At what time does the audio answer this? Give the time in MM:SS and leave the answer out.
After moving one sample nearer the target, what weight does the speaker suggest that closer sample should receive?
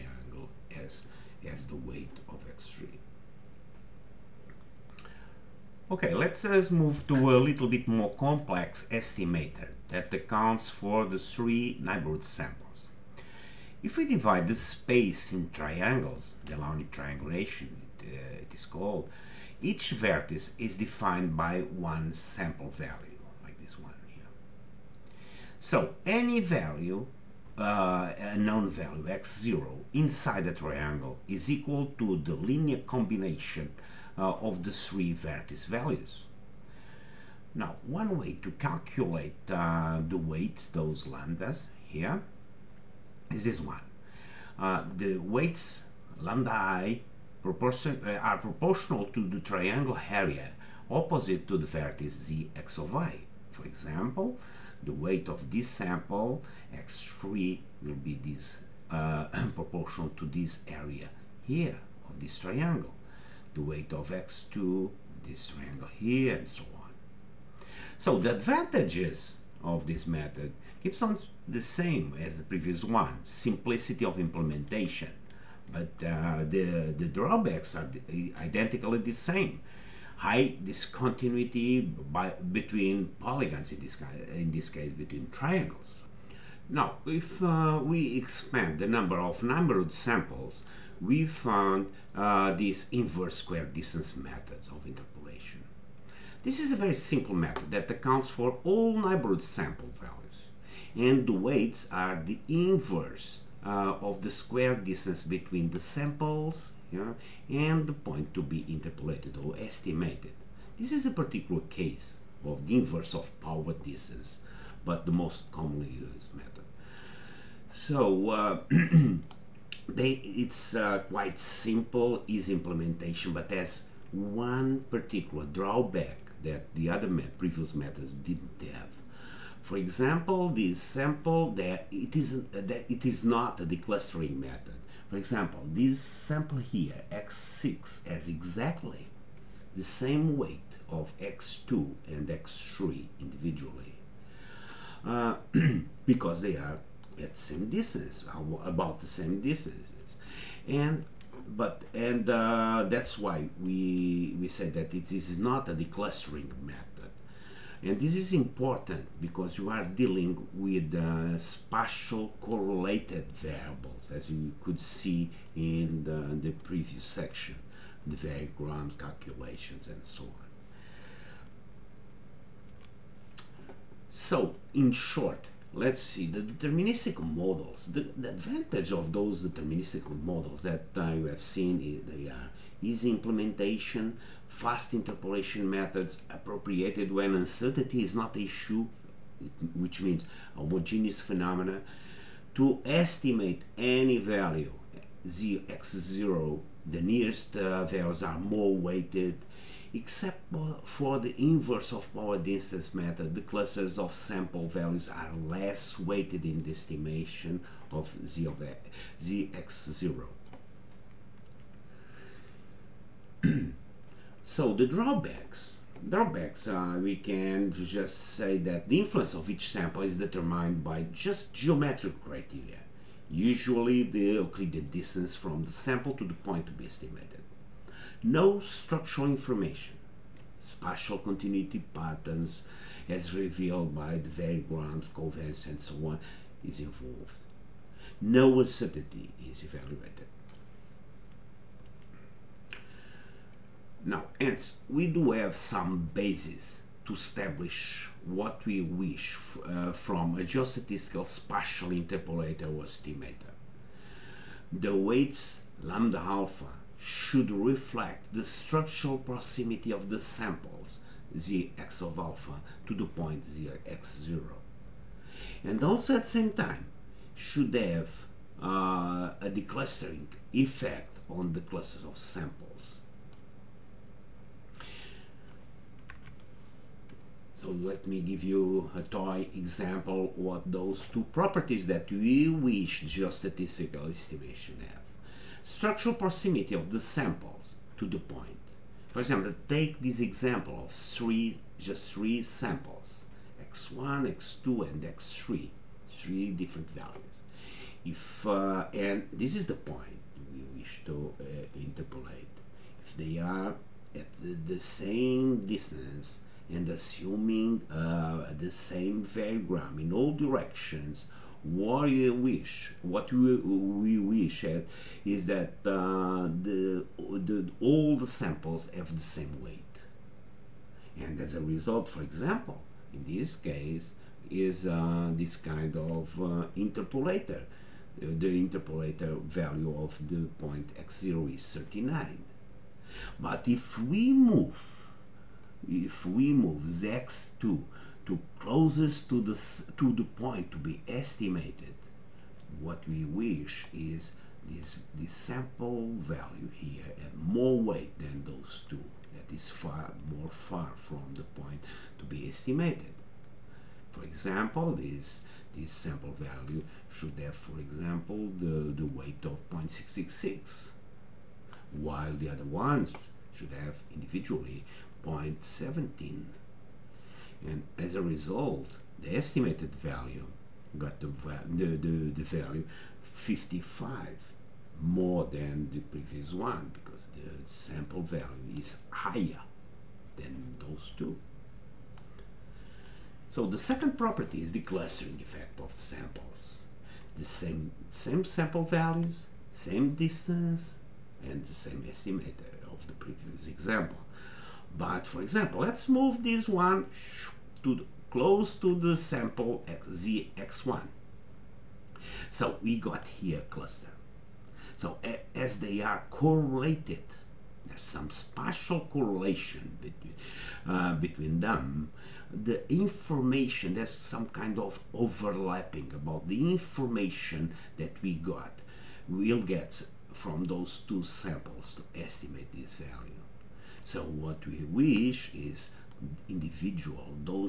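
05:59.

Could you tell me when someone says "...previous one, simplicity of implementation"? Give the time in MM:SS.
01:12.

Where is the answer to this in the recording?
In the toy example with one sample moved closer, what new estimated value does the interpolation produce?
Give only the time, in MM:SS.
06:13.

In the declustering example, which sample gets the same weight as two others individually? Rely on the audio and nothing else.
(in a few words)
x6.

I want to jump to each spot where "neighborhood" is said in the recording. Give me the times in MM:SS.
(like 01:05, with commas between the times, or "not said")
00:11, 01:38.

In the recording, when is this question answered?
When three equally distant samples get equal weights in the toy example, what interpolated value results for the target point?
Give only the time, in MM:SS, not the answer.
05:31.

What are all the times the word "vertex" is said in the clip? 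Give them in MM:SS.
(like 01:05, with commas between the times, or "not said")
00:19, 00:35, 00:51.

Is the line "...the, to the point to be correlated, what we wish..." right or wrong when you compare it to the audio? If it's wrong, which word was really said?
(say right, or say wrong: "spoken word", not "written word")
wrong: "estimated", not "correlated".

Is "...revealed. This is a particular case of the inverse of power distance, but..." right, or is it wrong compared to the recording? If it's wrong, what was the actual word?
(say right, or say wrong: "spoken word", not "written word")
wrong: "estimated", not "revealed".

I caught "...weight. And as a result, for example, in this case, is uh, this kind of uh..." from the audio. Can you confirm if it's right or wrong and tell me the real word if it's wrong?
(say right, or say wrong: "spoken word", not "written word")
right.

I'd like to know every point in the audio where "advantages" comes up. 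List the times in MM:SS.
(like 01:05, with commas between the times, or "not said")
01:08, 02:58.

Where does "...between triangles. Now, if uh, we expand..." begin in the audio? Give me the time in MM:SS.
01:24.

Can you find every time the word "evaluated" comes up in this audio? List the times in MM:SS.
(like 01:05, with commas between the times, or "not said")
03:59.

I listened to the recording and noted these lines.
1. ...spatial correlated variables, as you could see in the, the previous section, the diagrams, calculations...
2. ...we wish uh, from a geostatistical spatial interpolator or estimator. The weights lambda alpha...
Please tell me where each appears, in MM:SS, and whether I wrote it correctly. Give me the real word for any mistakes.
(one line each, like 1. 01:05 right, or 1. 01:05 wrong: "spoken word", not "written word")
1. 02:41 right
2. 04:08 right.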